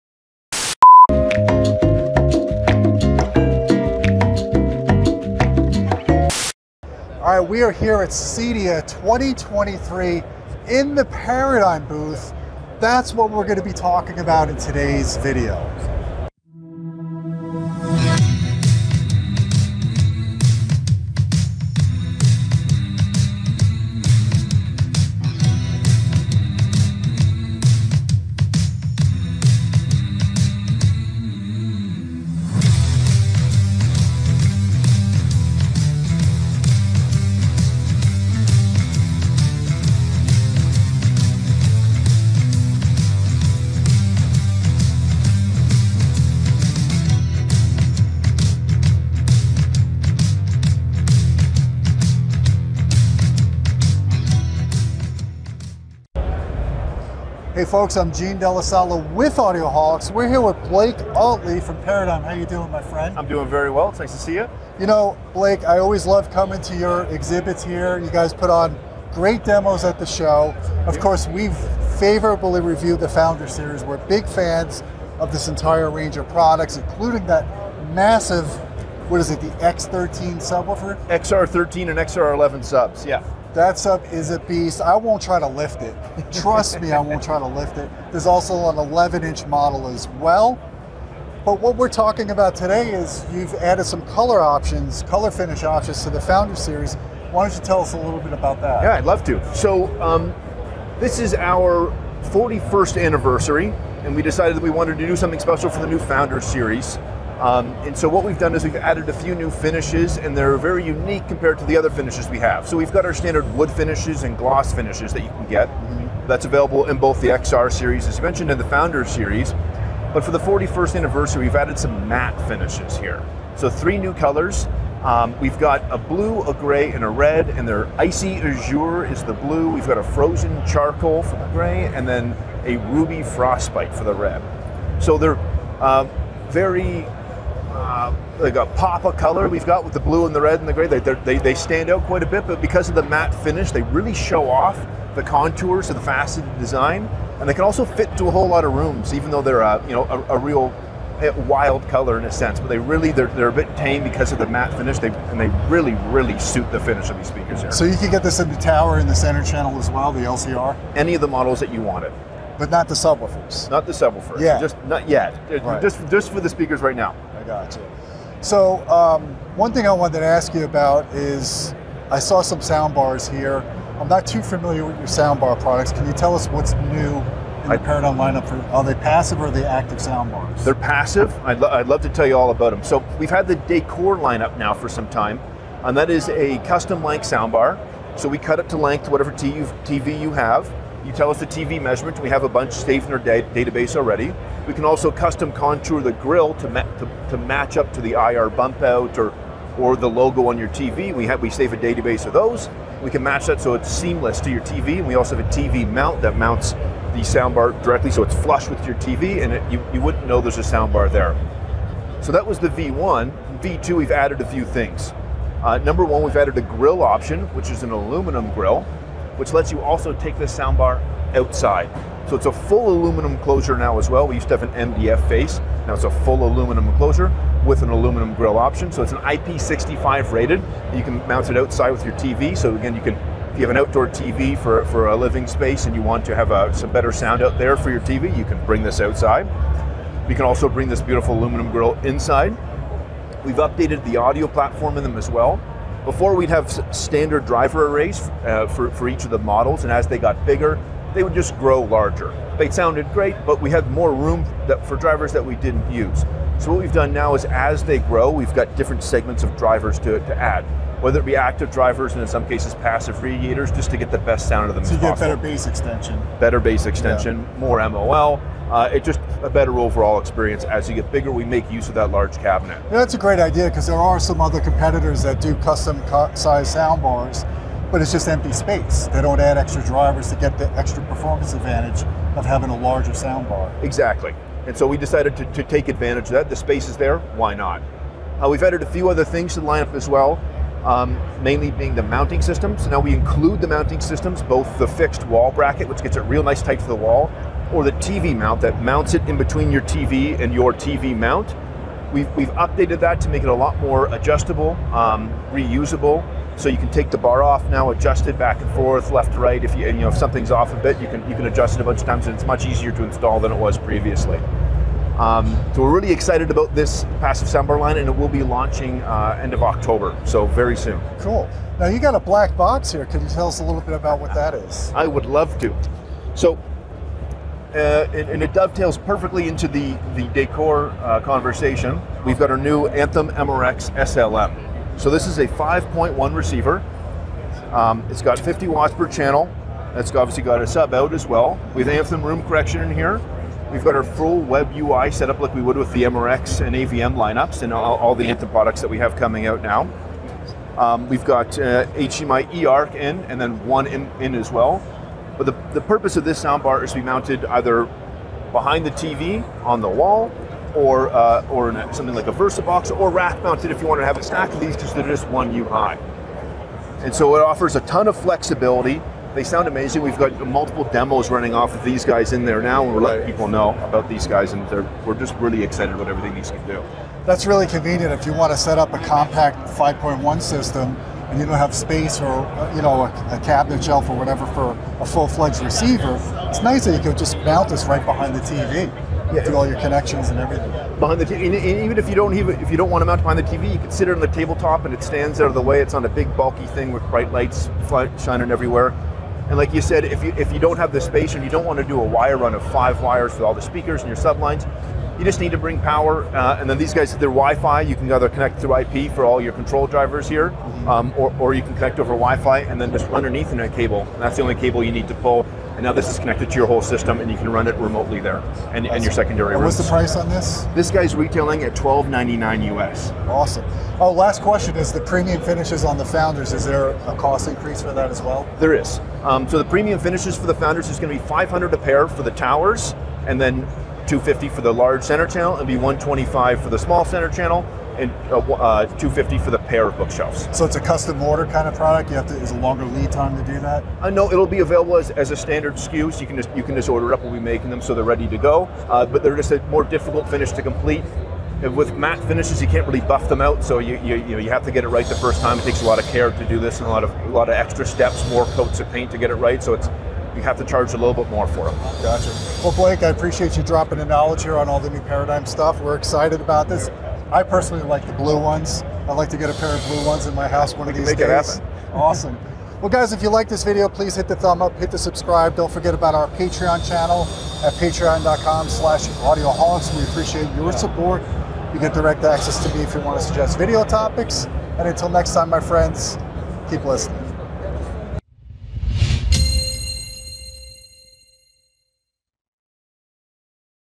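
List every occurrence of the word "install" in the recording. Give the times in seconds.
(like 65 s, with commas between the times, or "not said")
313 s.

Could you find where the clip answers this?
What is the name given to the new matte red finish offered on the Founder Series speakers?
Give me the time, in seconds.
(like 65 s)
132 s.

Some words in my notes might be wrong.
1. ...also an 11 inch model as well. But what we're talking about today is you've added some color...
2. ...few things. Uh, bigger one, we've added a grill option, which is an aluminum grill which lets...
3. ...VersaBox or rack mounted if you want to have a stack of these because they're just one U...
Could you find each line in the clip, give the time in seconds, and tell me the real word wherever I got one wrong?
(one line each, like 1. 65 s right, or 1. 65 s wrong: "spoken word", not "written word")
1. 88 s right
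2. 214 s wrong: "number", not "bigger"
3. 362 s right.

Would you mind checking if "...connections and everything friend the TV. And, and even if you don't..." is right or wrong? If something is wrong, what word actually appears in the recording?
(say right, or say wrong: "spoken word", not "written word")
wrong: "behind", not "friend".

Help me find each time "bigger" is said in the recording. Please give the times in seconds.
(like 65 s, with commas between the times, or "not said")
250 s, 271 s.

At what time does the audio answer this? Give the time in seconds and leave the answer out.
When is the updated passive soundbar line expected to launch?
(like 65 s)
319 s.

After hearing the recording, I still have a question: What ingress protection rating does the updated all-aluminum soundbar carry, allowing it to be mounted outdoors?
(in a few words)
IP65.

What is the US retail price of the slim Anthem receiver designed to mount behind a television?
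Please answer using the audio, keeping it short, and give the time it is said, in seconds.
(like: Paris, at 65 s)
$1,299, at 421 s.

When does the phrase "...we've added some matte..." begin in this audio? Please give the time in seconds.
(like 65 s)
121 s.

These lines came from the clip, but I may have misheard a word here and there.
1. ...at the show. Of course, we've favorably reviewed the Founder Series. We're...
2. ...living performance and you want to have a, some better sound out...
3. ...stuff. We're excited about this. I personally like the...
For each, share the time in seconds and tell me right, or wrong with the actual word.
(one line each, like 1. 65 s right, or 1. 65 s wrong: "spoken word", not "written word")
1. 69 s right
2. 235 s wrong: "space", not "performance"
3. 465 s right.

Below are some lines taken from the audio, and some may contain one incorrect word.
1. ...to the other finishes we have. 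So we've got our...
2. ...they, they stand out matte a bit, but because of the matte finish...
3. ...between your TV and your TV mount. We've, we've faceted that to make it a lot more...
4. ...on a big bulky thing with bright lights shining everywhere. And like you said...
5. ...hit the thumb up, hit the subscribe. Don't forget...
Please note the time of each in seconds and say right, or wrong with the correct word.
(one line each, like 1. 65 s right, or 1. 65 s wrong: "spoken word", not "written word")
1. 111 s right
2. 140 s wrong: "quite", not "matte"
3. 299 s wrong: "updated", not "faceted"
4. 395 s right
5. 474 s right.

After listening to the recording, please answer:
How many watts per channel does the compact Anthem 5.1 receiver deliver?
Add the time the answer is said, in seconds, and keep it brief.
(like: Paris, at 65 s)
50, at 338 s.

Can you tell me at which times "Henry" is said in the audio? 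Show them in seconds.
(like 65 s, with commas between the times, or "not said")
not said.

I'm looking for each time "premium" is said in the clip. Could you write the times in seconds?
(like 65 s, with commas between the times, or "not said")
425 s, 429 s.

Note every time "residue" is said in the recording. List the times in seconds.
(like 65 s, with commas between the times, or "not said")
not said.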